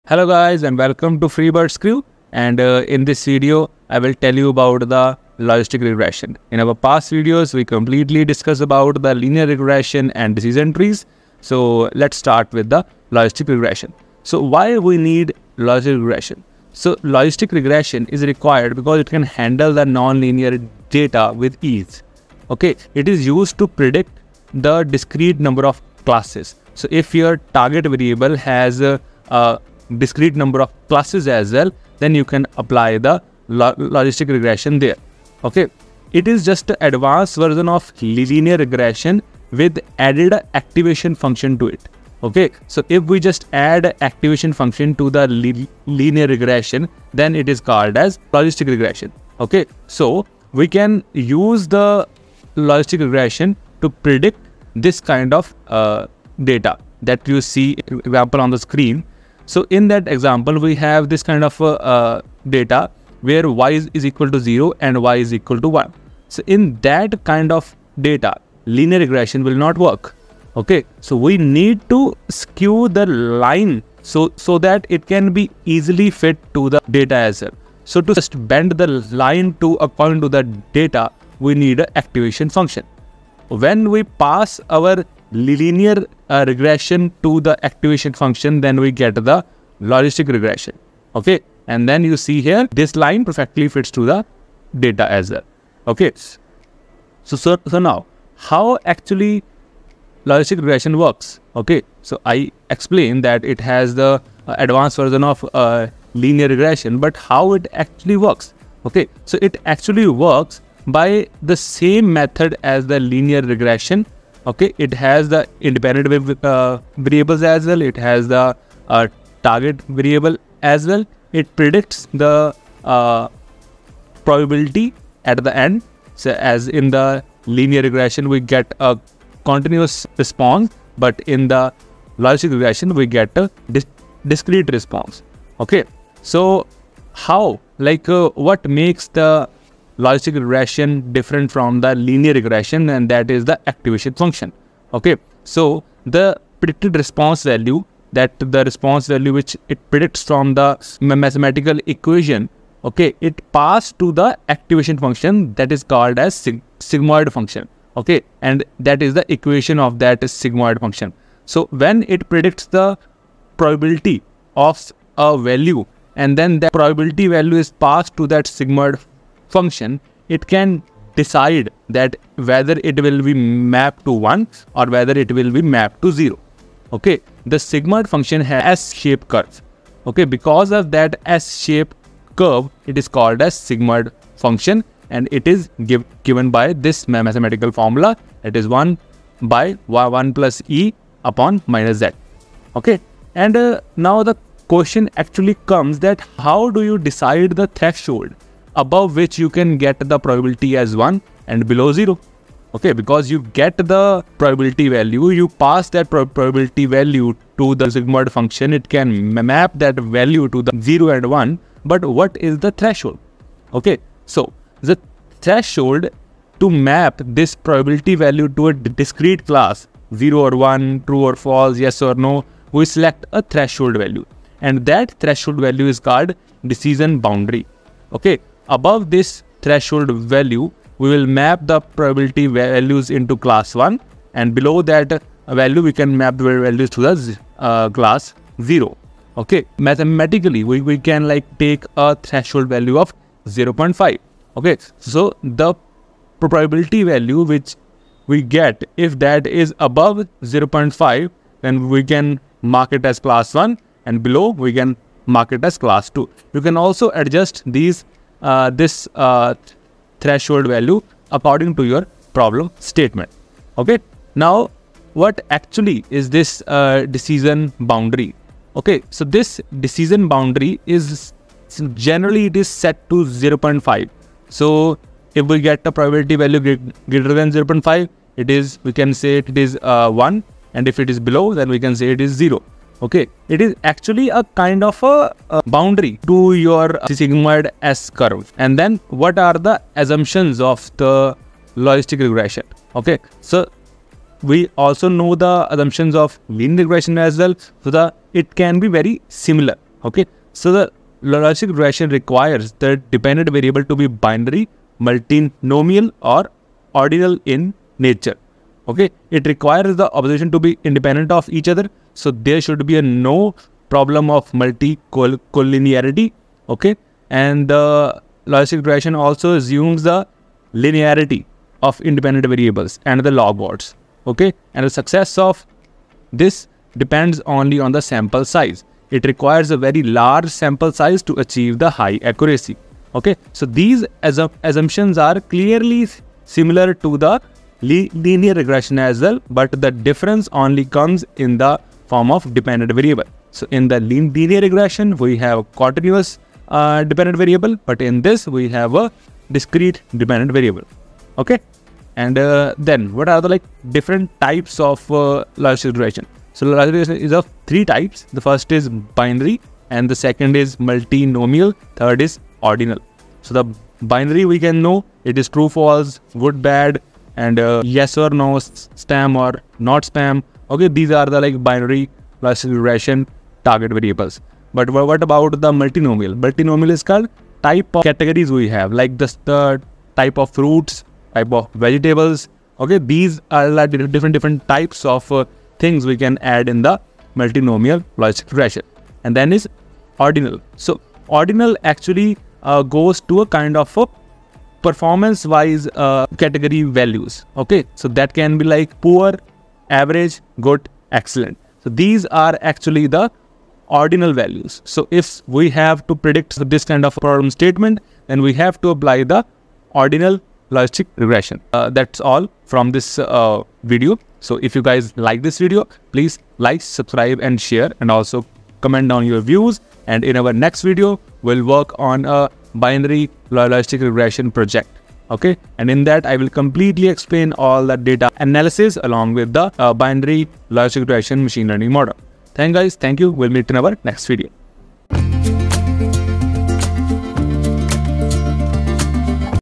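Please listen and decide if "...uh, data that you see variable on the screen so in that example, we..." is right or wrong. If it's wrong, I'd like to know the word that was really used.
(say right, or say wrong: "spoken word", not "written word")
wrong: "example", not "variable".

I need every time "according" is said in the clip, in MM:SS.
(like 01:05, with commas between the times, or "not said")
01:19, 04:21.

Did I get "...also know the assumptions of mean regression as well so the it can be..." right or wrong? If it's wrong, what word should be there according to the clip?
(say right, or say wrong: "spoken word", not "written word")
right.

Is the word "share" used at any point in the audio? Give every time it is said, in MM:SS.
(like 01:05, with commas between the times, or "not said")
06:57.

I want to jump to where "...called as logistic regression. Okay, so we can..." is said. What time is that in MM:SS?
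00:47.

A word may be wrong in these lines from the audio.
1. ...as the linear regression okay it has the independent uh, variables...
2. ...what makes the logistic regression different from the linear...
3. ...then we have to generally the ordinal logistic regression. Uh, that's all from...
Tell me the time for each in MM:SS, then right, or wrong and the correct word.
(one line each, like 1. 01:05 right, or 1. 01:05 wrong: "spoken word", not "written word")
1. 01:52 right
2. 02:18 right
3. 06:48 wrong: "apply", not "generally".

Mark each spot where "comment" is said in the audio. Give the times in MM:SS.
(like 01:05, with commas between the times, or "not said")
06:58.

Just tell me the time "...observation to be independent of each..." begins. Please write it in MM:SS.
05:10.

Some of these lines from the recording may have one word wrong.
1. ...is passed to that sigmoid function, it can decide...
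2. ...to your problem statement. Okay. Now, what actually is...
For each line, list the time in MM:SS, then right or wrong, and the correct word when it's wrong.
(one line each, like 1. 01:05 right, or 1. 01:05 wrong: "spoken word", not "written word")
1. 02:47 right
2. 04:21 right.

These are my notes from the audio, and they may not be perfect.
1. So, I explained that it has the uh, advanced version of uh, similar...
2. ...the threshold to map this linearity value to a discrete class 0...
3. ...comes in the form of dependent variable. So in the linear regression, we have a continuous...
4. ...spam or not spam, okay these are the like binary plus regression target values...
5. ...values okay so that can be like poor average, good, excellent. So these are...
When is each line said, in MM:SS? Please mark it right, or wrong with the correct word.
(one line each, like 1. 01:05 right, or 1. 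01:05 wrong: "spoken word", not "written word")
1. 01:42 wrong: "linear", not "similar"
2. 03:34 wrong: "probability", not "linearity"
3. 05:40 right
4. 06:09 wrong: "variables", not "values"
5. 06:36 right.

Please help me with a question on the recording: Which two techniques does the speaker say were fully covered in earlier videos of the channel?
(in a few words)
linear regression and decision trees.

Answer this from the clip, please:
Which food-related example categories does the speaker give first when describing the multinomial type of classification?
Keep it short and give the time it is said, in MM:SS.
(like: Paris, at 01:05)
type of fruits, at 06:20.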